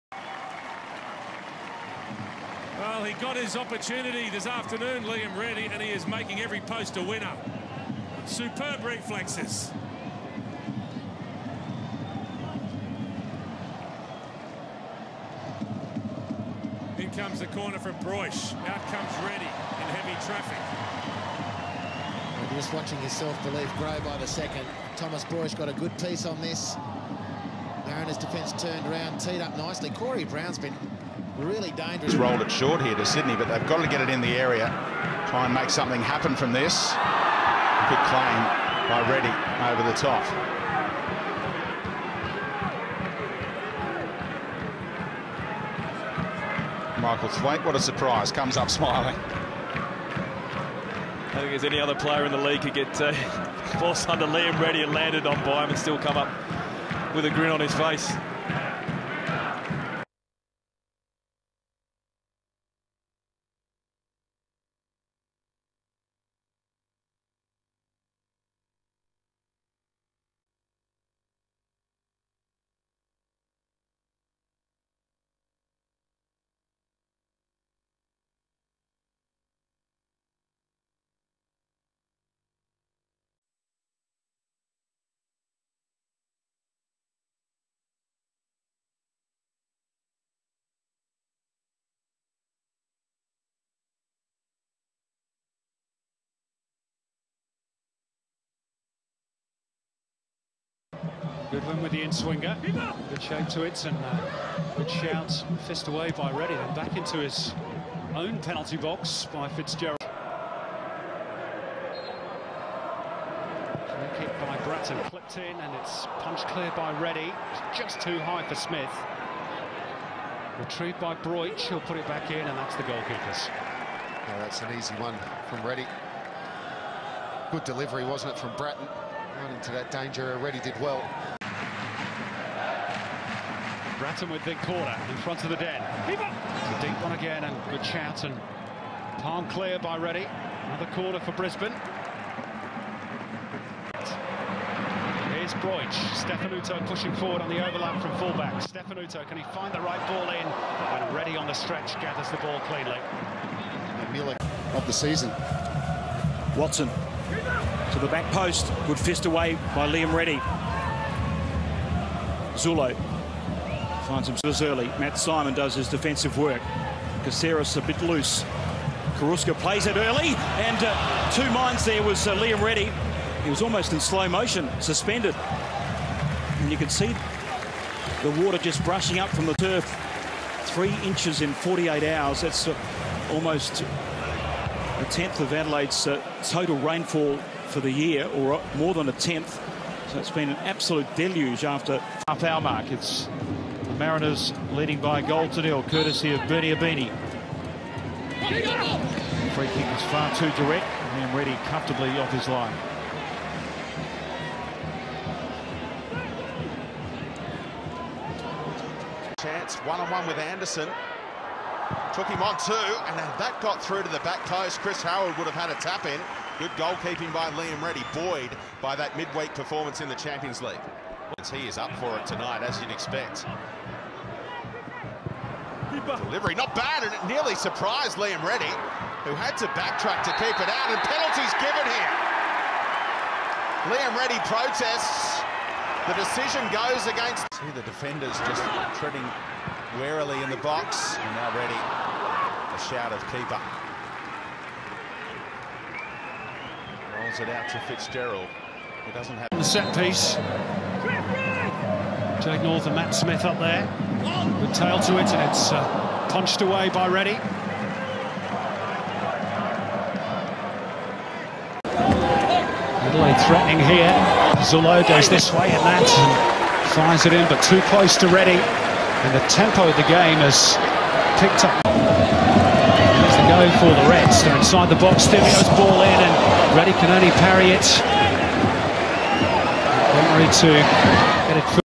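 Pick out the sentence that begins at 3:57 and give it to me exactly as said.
See the defenders just treading warily in the box.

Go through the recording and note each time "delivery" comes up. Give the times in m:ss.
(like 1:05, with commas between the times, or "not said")
2:07, 3:46.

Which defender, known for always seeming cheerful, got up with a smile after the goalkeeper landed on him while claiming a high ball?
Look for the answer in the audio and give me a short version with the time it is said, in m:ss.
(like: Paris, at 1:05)
Michael Thwaite, at 0:46.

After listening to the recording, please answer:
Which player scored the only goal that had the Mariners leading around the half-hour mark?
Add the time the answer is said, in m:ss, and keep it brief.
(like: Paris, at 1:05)
Bernie Ibini, at 3:16.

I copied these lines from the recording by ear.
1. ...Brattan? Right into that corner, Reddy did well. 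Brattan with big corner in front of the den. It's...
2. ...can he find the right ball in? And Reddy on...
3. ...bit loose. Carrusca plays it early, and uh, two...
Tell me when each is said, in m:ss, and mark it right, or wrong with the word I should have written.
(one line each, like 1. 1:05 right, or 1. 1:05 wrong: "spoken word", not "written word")
1. 2:08 wrong: "danger", not "corner"
2. 2:29 right
3. 2:47 right.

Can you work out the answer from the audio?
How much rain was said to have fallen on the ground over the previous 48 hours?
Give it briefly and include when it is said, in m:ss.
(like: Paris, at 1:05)
3 inches, at 3:00.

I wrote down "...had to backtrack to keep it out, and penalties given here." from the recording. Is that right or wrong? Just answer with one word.
right.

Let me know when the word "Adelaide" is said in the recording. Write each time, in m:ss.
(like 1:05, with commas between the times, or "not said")
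3:05, 4:23.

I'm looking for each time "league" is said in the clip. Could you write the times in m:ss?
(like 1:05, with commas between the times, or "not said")
0:52, 3:40.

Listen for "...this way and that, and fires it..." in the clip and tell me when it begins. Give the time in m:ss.
4:25.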